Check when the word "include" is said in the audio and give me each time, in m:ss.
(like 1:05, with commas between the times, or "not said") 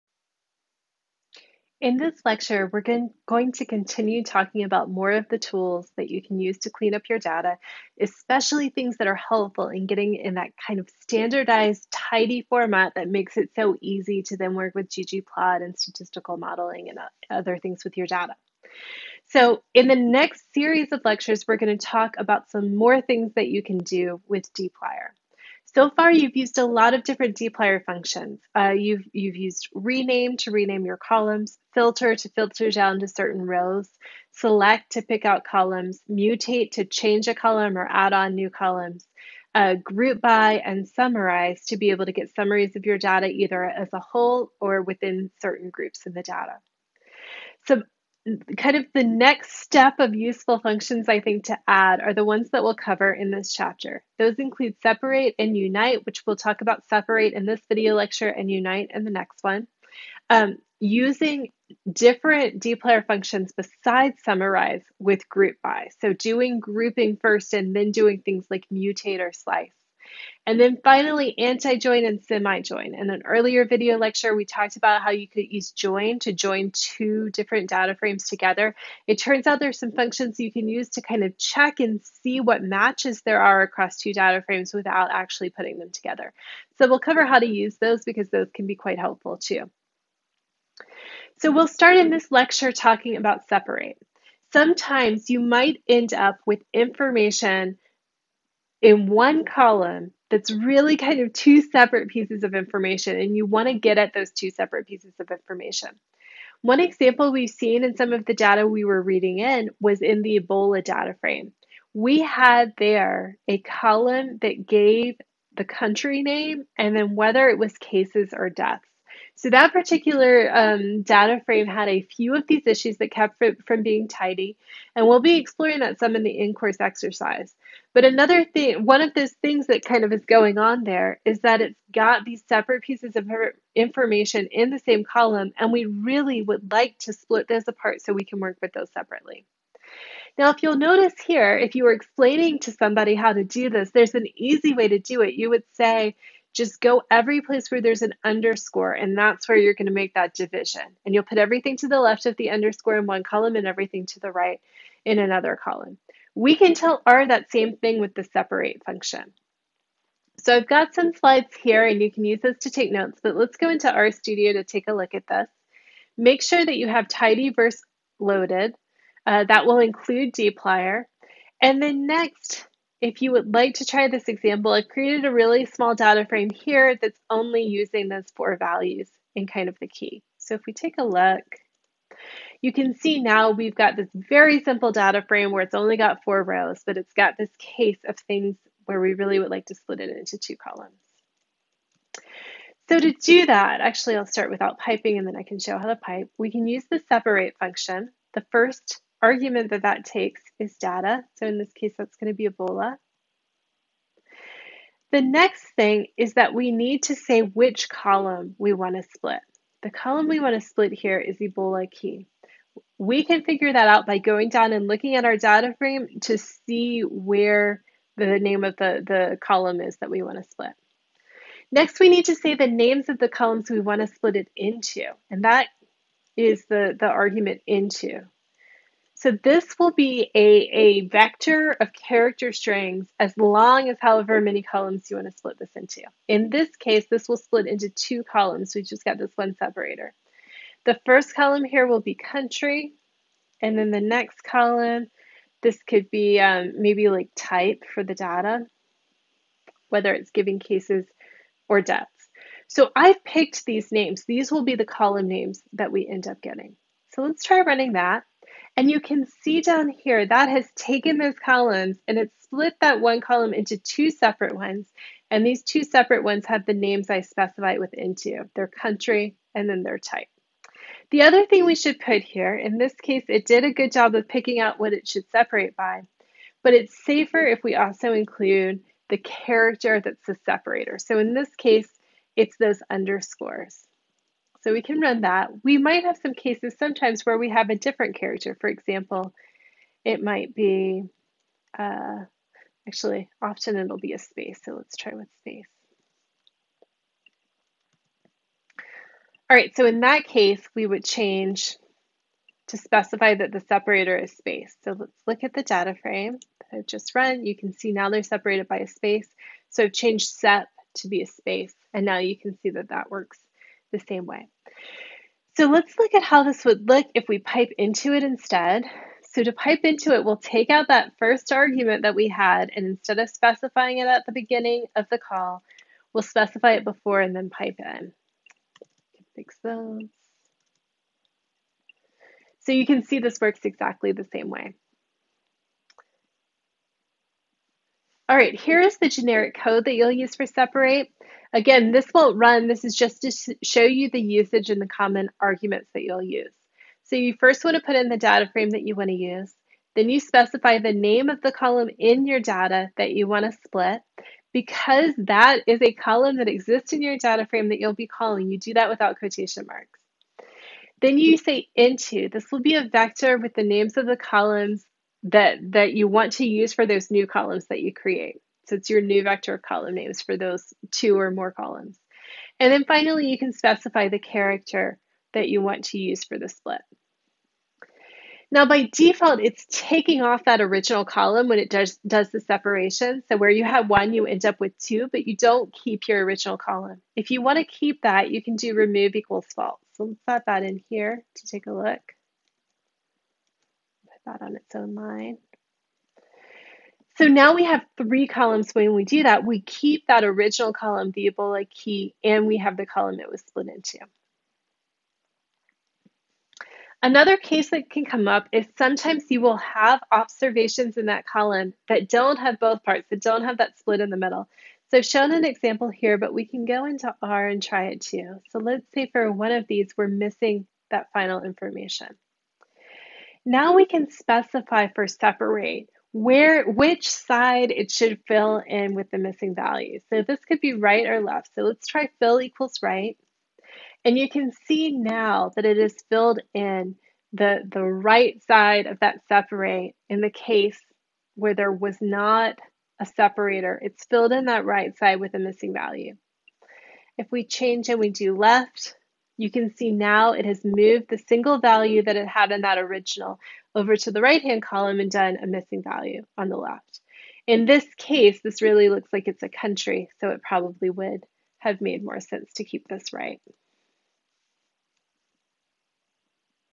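0:54, 2:49, 4:38.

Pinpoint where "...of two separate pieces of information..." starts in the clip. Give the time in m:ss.
1:41.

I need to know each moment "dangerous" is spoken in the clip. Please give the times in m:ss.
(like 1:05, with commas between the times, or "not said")
not said.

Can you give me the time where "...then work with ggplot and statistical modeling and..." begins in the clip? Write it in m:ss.
0:14.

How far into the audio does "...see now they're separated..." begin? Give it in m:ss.
5:07.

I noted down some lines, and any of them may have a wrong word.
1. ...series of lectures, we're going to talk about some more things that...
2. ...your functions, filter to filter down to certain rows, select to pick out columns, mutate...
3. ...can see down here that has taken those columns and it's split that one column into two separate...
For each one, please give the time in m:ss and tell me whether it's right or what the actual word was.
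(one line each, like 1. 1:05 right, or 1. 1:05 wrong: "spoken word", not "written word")
1. 0:20 right
2. 0:30 wrong: "columns", not "functions"
3. 4:18 right.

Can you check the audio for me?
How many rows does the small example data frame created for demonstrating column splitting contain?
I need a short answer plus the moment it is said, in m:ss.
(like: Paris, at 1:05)
4, at 3:06.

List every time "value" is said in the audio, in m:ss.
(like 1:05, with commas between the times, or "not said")
2:58, 7:09, 7:25, 7:31, 7:35.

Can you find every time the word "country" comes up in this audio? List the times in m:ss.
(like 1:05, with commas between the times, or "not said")
1:55, 4:02, 4:28, 7:39.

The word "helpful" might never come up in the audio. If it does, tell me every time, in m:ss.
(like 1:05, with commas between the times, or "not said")
0:09, 1:28.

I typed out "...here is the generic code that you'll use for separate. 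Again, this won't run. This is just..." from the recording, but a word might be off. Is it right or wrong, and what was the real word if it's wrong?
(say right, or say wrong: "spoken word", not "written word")
right.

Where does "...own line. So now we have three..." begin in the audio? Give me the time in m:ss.
6:34.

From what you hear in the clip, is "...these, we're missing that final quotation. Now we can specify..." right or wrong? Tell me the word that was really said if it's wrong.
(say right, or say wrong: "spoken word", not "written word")
wrong: "information", not "quotation".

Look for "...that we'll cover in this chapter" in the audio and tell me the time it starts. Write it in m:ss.
0:52.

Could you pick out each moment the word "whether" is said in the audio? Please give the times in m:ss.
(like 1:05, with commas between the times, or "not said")
1:57, 4:09.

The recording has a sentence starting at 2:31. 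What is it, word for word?
And you'll put everything to the left of the underscore in one column and everything to the right in another column.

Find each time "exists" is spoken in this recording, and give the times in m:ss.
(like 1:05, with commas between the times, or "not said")
5:56.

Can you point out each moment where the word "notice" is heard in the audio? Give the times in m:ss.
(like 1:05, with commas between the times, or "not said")
2:20.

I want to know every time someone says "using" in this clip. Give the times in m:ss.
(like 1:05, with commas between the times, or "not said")
1:00, 2:57.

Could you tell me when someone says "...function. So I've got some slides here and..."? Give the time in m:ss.
2:38.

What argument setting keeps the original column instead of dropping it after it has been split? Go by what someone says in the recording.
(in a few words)
remove equals false.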